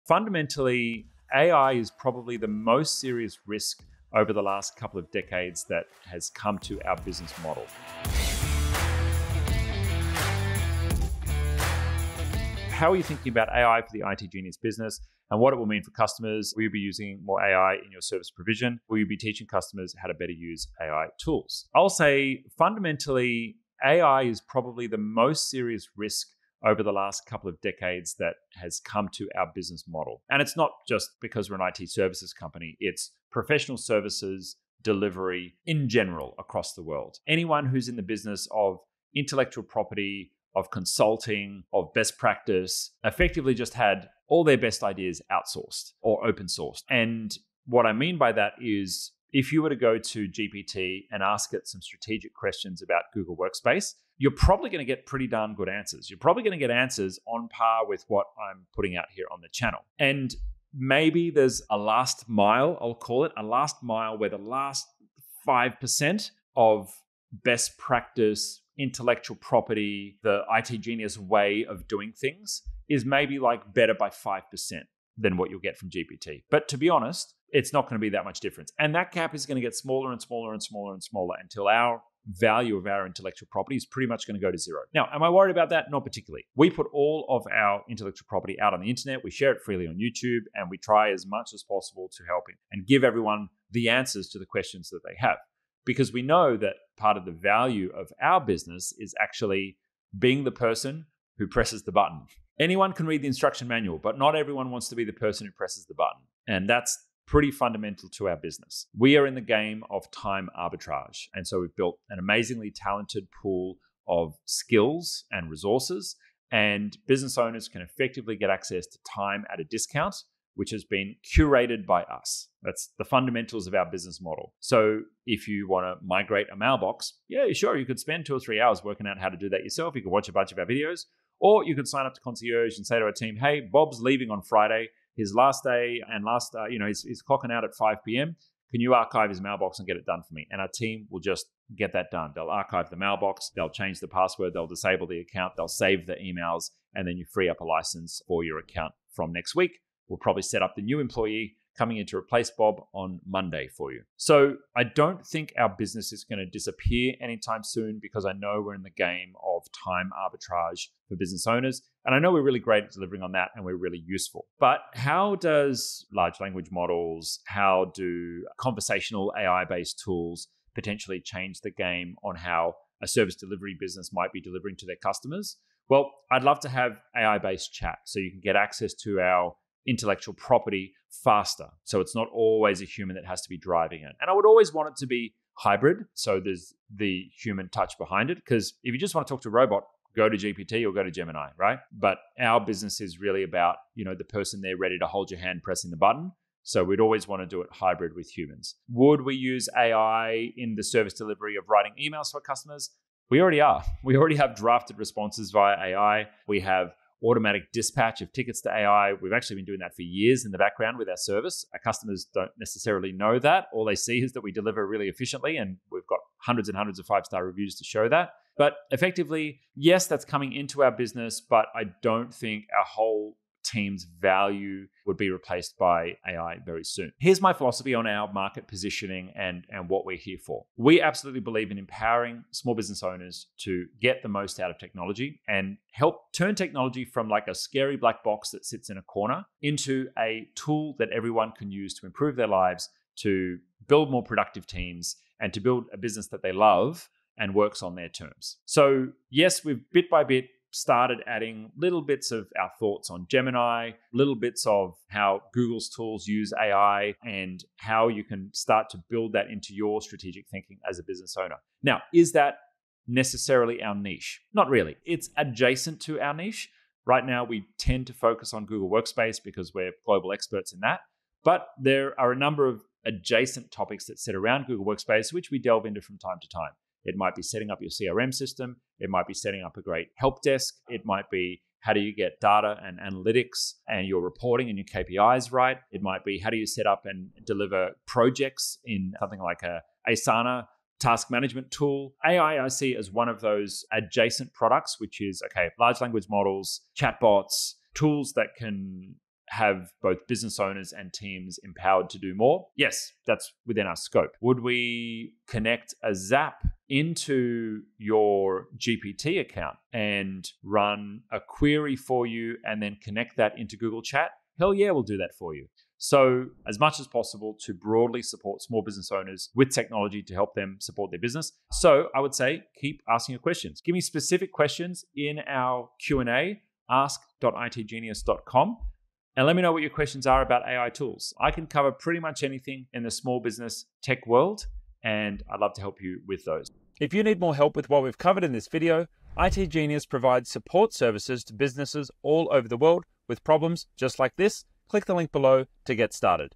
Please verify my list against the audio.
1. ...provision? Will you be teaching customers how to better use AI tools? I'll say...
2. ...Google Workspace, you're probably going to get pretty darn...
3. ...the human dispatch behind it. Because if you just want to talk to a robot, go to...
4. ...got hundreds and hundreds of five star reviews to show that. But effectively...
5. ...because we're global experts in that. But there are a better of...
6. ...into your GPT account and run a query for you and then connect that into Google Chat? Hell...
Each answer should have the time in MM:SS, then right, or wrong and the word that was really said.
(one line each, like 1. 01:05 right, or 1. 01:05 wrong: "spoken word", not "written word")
1. 00:18 right
2. 00:53 right
3. 03:06 wrong: "touch", not "dispatch"
4. 03:36 right
5. 04:29 wrong: "number", not "better"
6. 05:06 right.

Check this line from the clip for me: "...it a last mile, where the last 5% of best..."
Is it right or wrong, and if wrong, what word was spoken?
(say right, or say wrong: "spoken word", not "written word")
right.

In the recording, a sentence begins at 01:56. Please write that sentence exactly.
And business owners can effectively get access to time at a discount which has been curated by us.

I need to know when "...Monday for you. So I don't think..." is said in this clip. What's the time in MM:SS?
02:33.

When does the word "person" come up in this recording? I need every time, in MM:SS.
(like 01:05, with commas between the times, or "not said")
01:40, 01:45, 03:14.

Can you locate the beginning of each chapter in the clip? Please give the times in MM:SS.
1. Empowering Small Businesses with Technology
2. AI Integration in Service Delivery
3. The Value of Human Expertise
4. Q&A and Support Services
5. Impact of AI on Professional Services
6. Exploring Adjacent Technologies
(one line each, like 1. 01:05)
1. 03:47
2. 02:44
3. 01:25
4. 05:21
5. 00:21
6. 04:26.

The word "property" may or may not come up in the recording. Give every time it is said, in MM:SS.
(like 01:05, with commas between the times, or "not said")
00:39, 01:09, 01:23, 01:28, 03:00.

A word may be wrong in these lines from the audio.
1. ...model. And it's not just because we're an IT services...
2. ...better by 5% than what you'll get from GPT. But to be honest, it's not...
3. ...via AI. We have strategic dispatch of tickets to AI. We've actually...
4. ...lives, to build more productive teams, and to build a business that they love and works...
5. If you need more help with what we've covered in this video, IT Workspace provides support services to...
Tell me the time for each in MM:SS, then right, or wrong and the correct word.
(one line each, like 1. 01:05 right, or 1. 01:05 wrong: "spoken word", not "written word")
1. 00:29 right
2. 01:13 right
3. 03:25 wrong: "automatic", not "strategic"
4. 04:02 right
5. 05:36 wrong: "Genius", not "Workspace".